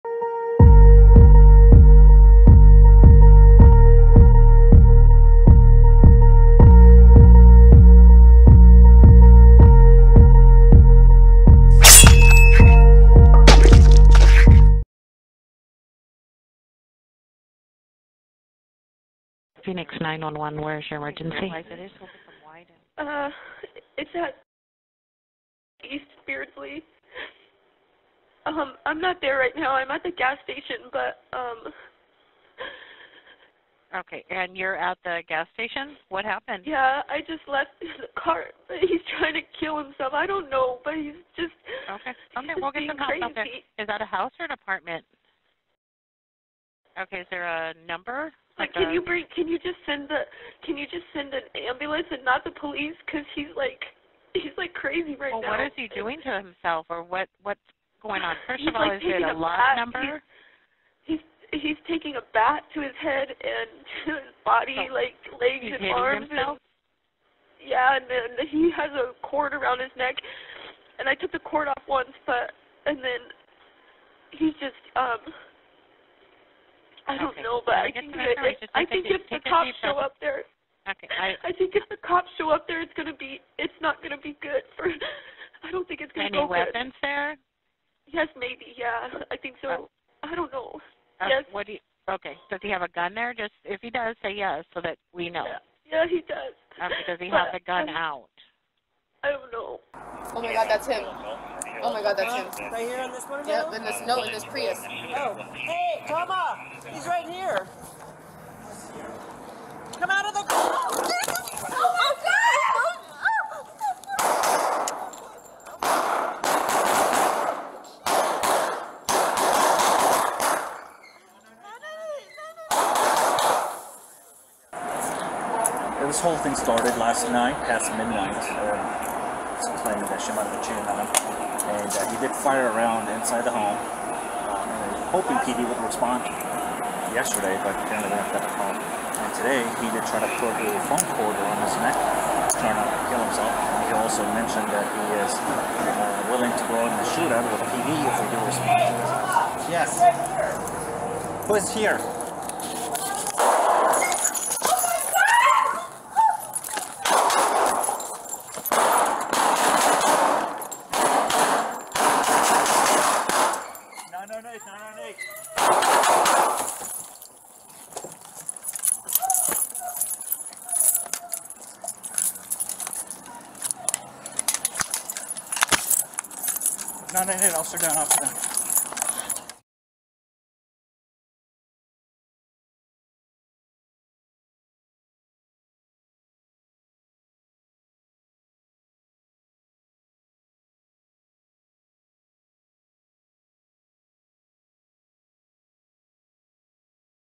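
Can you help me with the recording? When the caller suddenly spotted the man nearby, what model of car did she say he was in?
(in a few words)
Prius.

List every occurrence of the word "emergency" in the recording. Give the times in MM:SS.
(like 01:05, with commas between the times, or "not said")
00:20.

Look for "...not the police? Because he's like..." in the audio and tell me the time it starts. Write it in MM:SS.
00:52.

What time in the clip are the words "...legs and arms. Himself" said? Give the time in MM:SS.
01:05.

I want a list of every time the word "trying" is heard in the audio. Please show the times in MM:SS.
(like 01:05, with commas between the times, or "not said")
00:39, 02:22.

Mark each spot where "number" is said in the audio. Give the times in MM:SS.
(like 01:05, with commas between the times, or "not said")
00:47, 00:59.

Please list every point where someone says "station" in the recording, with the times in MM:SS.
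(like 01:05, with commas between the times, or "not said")
00:30, 00:35.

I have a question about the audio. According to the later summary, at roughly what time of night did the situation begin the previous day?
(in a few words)
past midnight.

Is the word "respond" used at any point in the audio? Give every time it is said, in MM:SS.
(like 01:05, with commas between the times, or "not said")
02:15, 02:28.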